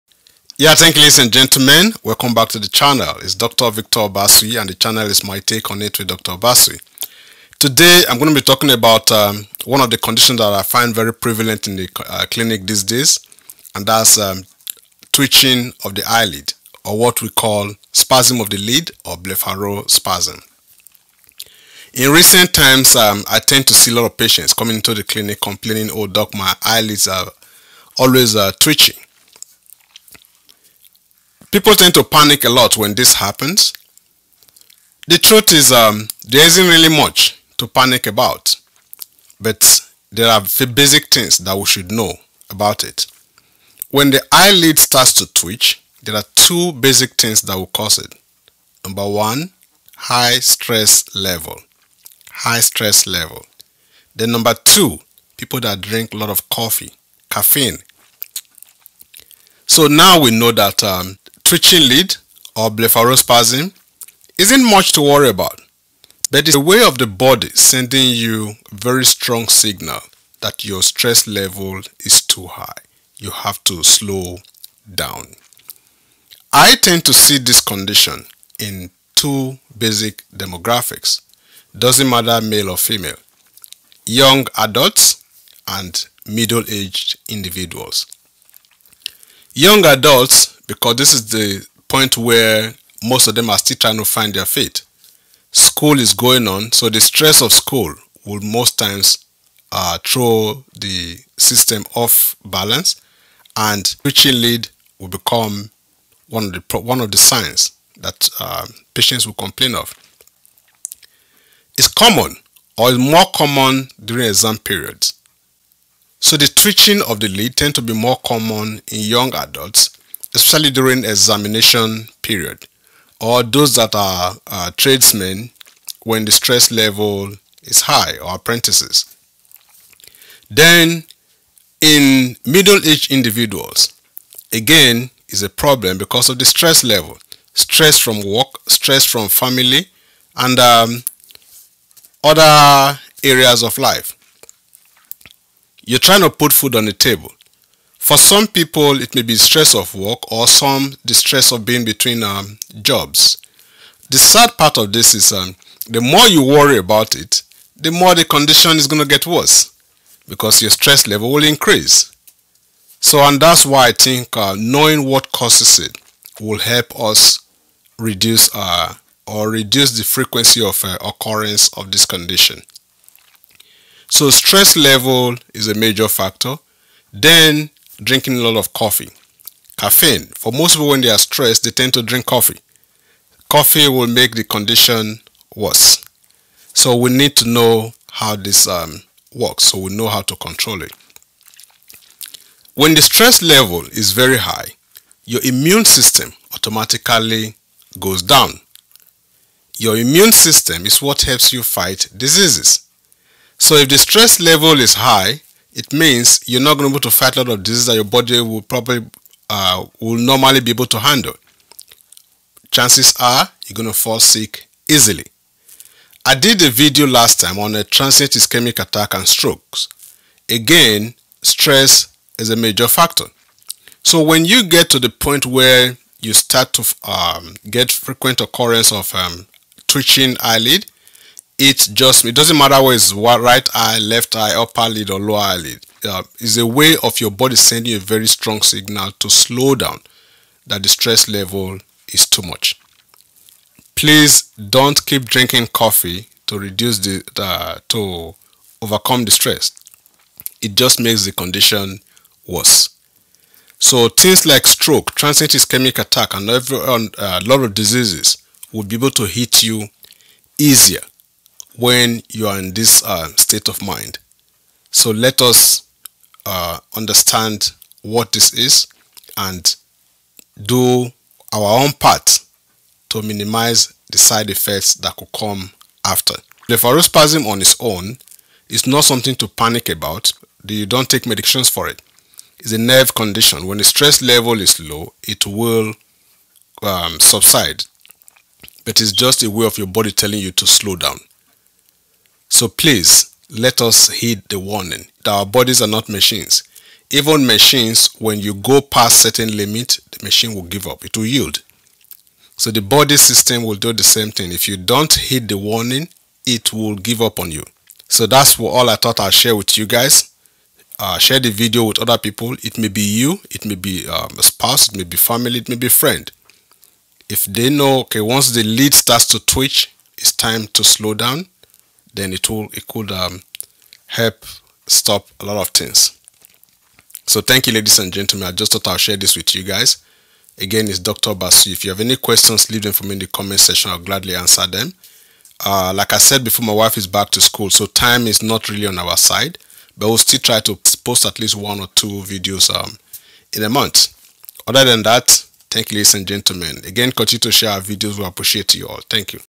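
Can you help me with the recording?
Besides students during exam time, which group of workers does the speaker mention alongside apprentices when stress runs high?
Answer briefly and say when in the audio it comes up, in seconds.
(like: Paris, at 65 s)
tradesmen, at 124 s.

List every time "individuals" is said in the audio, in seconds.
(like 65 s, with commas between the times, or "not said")
87 s, 133 s.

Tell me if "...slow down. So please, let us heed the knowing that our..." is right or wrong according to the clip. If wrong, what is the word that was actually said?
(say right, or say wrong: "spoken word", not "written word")
wrong: "warning", not "knowing".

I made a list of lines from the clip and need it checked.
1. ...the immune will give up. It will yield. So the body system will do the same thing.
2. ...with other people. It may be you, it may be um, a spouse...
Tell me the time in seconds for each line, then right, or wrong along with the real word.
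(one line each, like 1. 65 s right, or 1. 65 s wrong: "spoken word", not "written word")
1. 300 s wrong: "machine", not "immune"
2. 311 s right.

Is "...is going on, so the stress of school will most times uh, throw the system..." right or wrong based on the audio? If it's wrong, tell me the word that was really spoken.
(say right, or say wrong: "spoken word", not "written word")
right.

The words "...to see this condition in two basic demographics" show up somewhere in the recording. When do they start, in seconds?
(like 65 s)
77 s.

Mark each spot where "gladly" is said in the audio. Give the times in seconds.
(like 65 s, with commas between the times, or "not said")
333 s.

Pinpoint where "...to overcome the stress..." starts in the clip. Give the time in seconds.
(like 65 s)
247 s.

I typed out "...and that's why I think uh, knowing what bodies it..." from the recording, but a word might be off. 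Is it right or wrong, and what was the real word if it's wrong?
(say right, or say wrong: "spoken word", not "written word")
wrong: "causes", not "bodies".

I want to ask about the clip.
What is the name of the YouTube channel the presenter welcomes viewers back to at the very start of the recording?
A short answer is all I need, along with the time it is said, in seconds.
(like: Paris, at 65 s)
My Take on It, at 5 s.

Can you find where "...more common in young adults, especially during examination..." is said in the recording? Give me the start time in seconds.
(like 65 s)
117 s.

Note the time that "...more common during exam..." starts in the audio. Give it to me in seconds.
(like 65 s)
112 s.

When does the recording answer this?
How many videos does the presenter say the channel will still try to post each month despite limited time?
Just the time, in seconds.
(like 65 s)
341 s.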